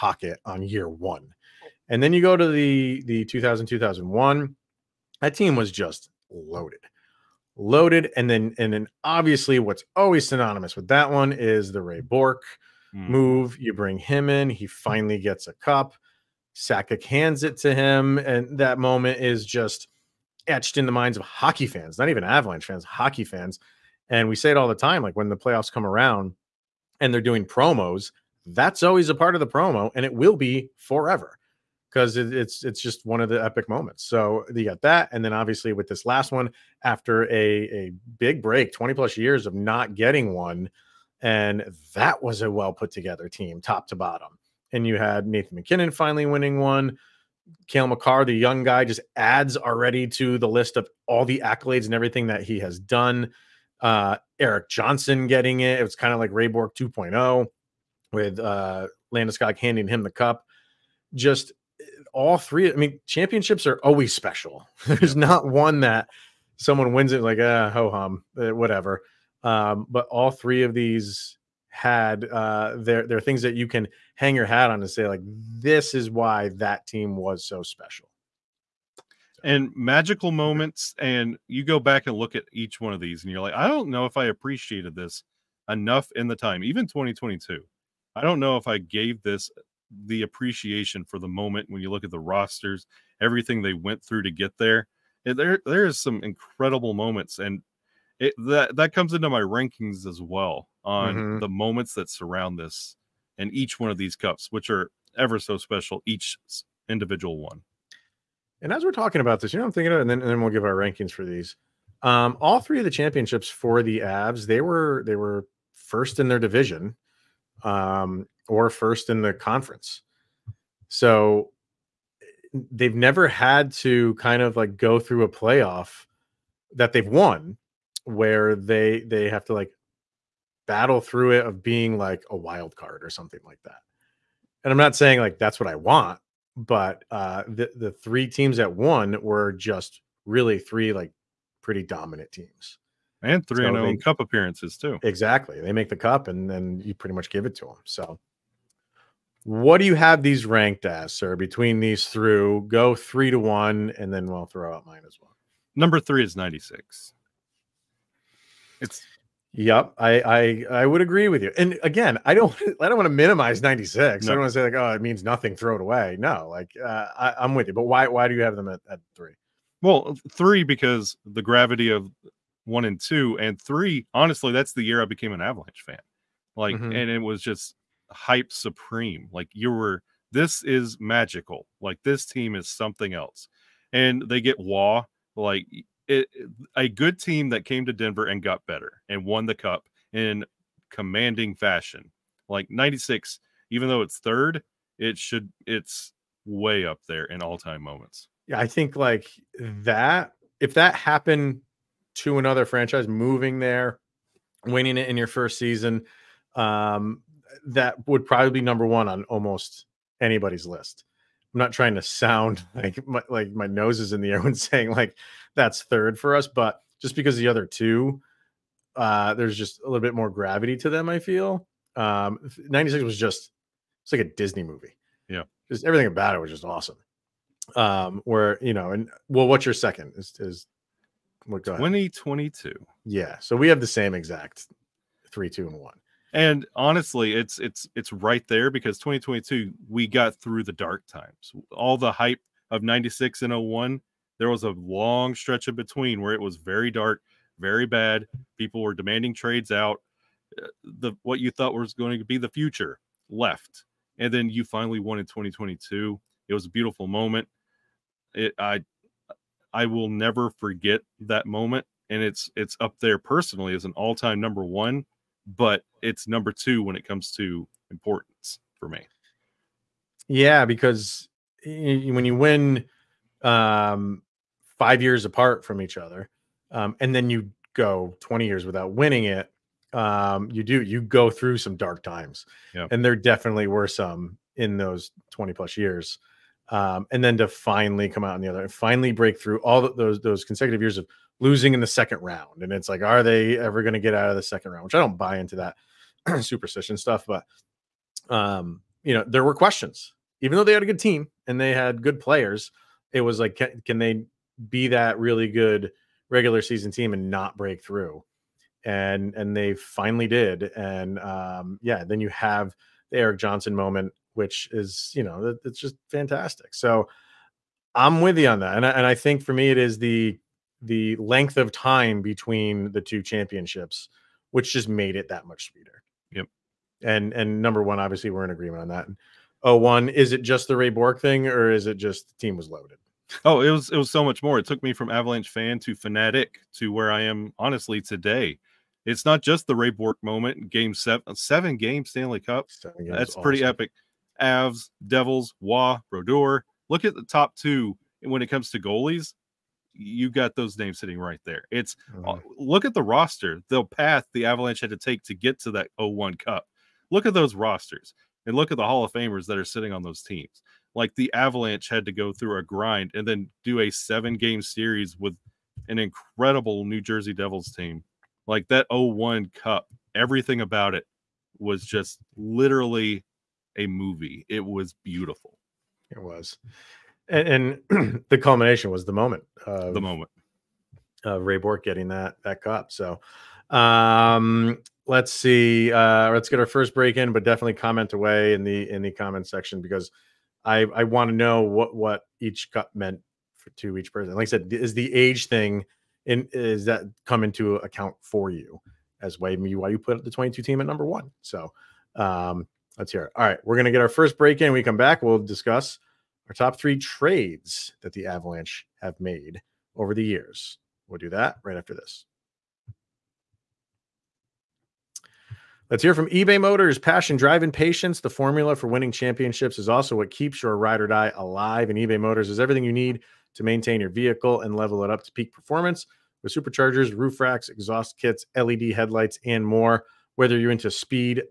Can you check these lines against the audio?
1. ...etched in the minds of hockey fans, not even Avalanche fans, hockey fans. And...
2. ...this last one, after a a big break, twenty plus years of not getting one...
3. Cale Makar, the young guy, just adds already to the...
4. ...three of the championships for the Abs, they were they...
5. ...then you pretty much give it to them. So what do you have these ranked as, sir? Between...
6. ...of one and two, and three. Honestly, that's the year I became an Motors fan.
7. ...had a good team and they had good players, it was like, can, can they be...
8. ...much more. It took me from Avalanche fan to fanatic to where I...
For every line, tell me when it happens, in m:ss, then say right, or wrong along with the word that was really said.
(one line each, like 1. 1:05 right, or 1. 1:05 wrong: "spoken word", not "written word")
1. 0:20 right
2. 0:35 right
3. 0:47 right
4. 1:52 right
5. 2:26 right
6. 2:51 wrong: "Avalanche", not "Motors"
7. 5:00 right
8. 5:34 right.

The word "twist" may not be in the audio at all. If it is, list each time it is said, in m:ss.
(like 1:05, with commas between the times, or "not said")
not said.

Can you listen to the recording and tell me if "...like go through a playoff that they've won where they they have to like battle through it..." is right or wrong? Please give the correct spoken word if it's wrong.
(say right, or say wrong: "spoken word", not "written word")
right.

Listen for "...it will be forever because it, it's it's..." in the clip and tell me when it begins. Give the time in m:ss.
0:30.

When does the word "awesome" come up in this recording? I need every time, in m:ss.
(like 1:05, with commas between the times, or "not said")
3:46, 5:43.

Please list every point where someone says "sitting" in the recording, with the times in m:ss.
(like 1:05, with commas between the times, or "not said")
5:50, 5:59.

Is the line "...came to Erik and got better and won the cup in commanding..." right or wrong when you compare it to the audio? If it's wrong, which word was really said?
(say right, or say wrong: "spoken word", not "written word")
wrong: "Denver", not "Erik".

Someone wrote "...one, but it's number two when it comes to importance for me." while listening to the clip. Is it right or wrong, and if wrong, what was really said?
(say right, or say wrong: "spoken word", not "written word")
right.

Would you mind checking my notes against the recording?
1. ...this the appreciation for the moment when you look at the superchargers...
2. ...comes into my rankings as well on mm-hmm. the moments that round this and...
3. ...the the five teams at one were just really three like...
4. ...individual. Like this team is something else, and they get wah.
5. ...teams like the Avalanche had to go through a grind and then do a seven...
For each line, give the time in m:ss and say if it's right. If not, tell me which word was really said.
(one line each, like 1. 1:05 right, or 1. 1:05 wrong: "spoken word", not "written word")
1. 1:29 wrong: "rosters", not "superchargers"
2. 1:38 wrong: "surround", not "round"
3. 2:17 wrong: "three", not "five"
4. 3:00 wrong: "magical", not "individual"
5. 6:00 right.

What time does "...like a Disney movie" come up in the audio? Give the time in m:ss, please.
3:44.